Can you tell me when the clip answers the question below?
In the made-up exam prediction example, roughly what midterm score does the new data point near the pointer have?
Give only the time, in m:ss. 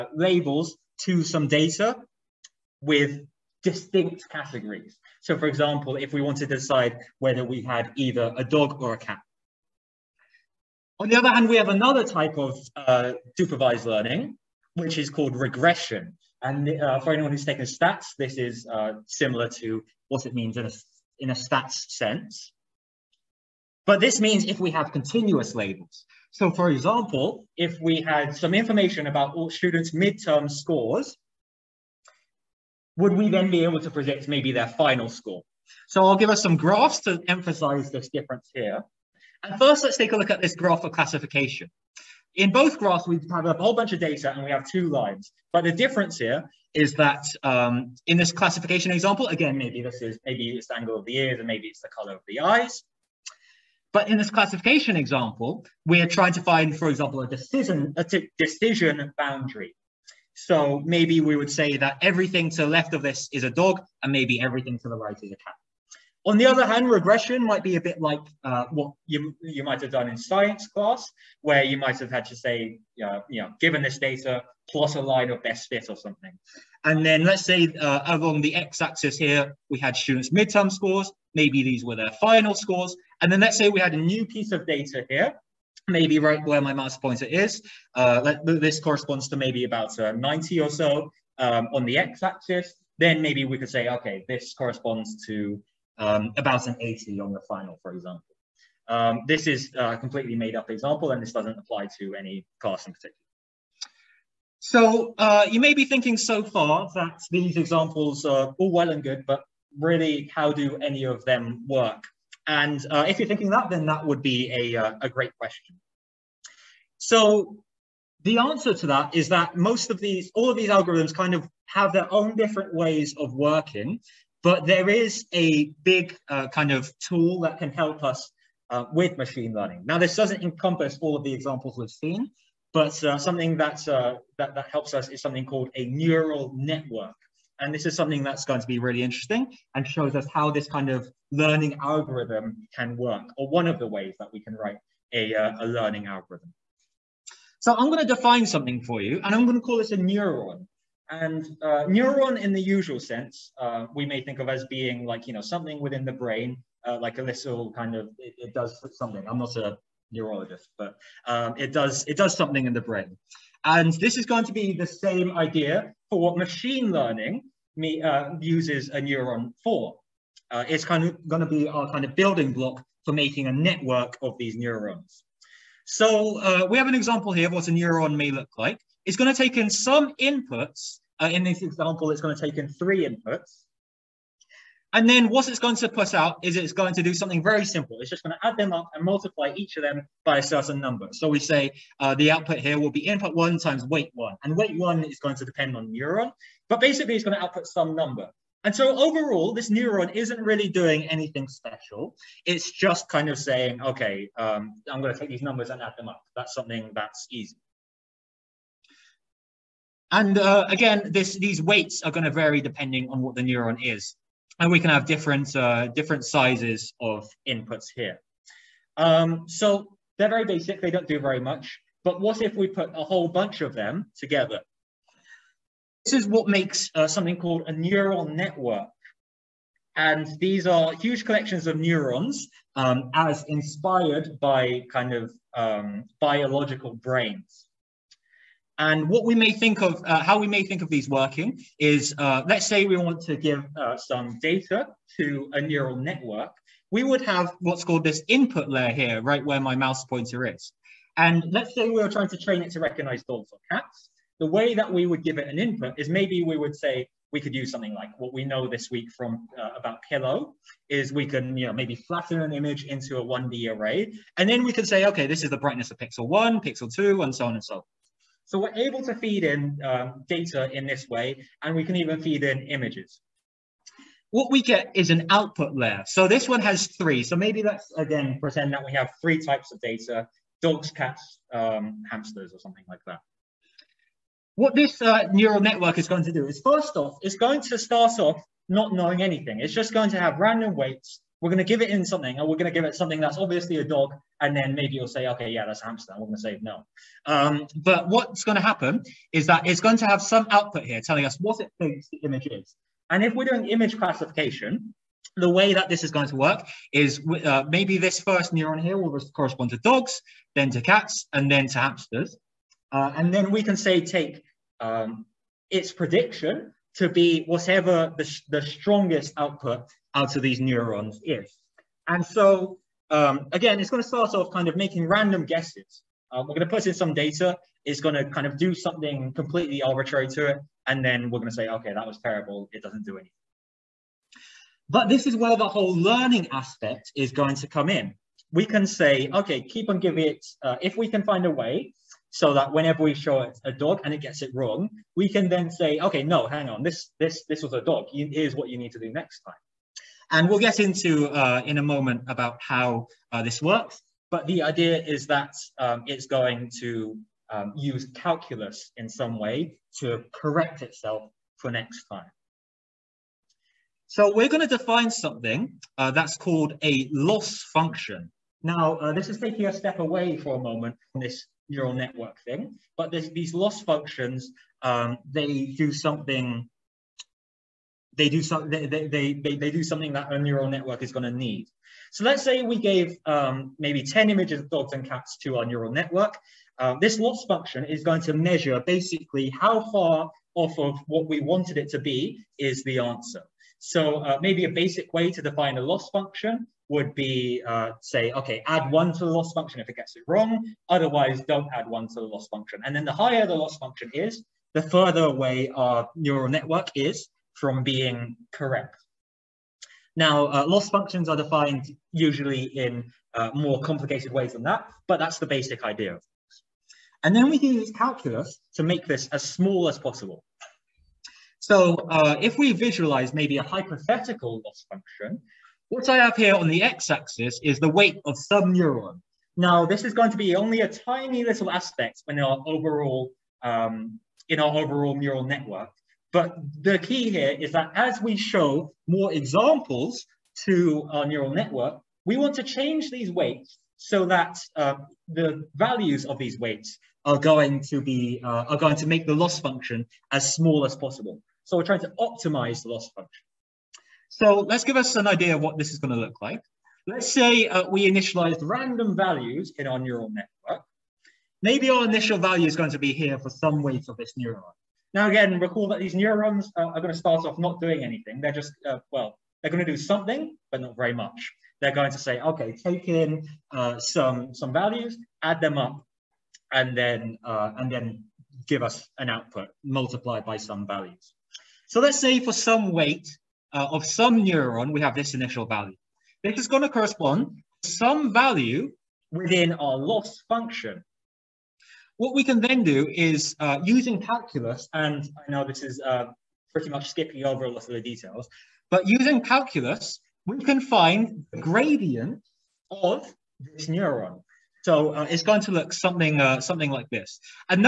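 1:30.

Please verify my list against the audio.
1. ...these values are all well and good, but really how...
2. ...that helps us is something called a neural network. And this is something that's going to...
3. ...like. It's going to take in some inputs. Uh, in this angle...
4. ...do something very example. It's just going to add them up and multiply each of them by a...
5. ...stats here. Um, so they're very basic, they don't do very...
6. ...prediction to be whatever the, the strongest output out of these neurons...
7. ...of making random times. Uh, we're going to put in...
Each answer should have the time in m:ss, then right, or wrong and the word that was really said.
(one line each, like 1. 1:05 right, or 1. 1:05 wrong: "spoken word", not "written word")
1. 1:47 wrong: "examples", not "values"
2. 2:14 right
3. 2:58 wrong: "example", not "angle"
4. 3:07 wrong: "simple", not "example"
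5. 3:37 wrong: "inputs", not "stats"
6. 5:15 right
7. 5:24 wrong: "guesses", not "times".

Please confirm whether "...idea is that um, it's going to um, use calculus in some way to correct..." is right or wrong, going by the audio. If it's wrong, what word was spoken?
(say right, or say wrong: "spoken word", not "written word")
right.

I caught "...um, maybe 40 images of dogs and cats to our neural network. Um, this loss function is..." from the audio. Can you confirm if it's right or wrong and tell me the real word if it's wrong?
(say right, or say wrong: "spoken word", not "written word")
wrong: "10", not "40".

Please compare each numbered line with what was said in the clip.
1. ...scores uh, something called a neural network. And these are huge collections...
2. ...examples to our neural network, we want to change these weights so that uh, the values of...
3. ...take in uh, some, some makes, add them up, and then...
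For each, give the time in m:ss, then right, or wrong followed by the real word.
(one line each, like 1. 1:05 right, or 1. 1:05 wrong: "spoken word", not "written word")
1. 3:46 wrong: "makes", not "scores"
2. 7:19 right
3. 7:52 wrong: "values", not "makes".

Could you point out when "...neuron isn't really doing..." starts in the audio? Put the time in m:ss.
3:19.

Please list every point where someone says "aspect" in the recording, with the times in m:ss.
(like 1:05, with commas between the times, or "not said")
5:36, 7:11.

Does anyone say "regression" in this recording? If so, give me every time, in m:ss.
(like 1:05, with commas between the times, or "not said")
0:15, 1:06.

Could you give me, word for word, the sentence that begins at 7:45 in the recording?
Now again, recall that these neurons uh, are going to start off not doing anything.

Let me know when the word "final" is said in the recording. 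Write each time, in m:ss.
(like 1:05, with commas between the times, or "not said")
0:34, 1:22, 1:37.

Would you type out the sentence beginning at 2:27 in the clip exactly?
So I'm going to define something for you, and I'm going to call this a neuron.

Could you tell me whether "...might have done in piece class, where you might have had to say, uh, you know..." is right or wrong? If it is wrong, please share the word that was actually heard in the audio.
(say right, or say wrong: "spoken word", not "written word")
wrong: "science", not "piece".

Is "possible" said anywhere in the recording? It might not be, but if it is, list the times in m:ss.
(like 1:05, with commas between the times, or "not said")
6:59, 7:30.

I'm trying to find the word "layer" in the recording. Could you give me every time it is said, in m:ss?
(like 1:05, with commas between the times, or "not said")
4:08, 4:35.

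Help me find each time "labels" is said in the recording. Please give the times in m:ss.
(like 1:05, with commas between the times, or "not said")
0:00, 0:25.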